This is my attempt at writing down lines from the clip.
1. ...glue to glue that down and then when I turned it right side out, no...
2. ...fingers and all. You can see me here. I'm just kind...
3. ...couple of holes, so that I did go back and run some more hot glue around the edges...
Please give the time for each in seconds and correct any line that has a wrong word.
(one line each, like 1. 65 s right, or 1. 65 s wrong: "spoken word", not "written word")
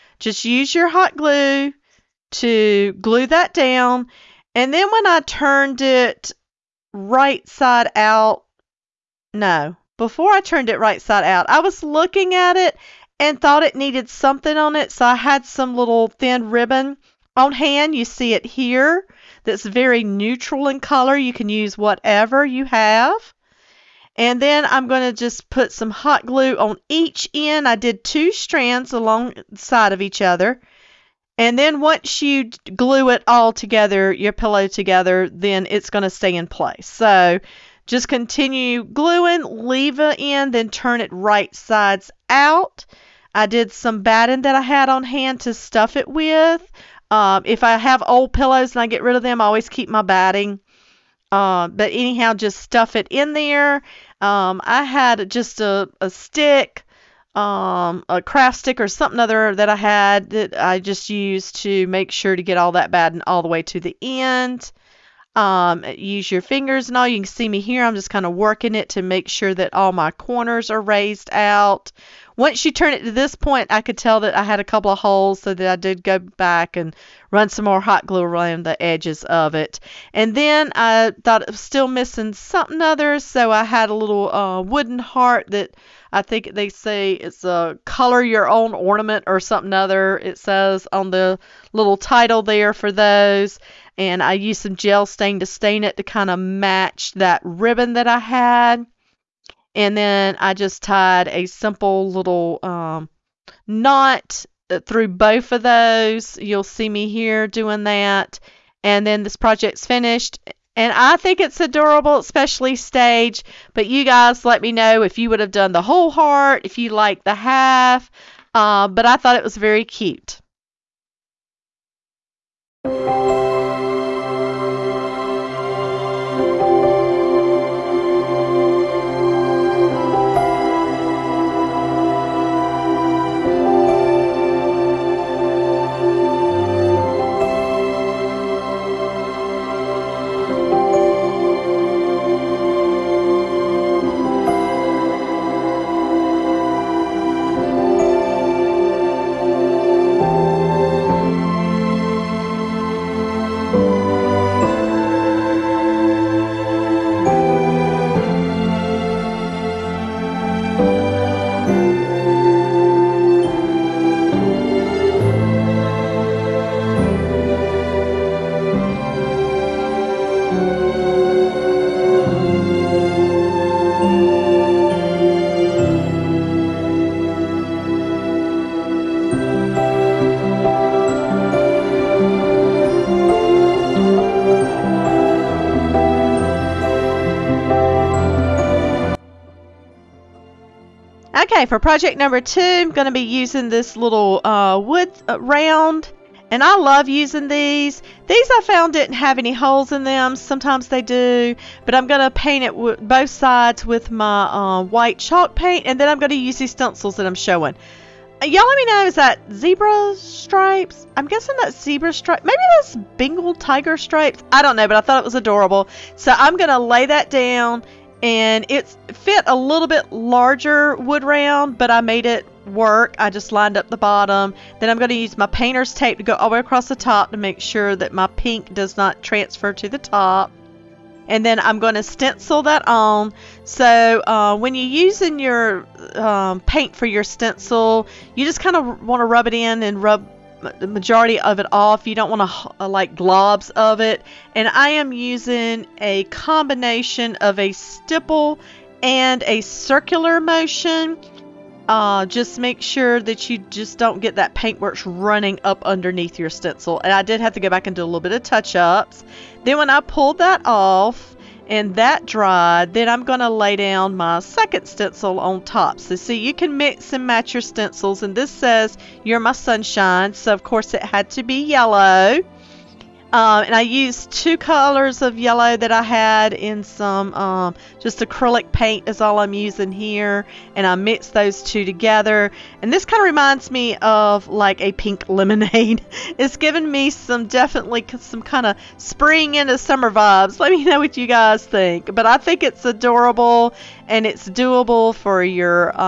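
1. 1 s right
2. 66 s right
3. 74 s right.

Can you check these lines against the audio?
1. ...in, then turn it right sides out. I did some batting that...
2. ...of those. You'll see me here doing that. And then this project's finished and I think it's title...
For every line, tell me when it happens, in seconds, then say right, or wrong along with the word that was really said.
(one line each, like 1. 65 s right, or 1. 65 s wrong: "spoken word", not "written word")
1. 40 s right
2. 105 s wrong: "adorable", not "title".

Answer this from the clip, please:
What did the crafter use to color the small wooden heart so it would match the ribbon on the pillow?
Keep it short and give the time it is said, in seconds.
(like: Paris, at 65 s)
Gel stain, at 94 s.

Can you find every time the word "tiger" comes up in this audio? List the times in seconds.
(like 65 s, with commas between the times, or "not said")
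213 s.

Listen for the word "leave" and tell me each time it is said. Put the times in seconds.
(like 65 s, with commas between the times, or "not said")
39 s.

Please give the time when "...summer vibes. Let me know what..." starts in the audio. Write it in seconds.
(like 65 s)
289 s.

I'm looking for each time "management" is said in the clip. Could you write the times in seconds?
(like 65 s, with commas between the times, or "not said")
not said.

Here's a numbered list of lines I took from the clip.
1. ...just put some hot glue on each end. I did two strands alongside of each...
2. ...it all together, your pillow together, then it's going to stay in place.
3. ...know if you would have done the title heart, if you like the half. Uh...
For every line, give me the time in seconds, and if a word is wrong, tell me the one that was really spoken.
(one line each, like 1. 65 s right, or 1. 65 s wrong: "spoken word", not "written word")
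1. 25 s right
2. 33 s right
3. 114 s wrong: "whole", not "title".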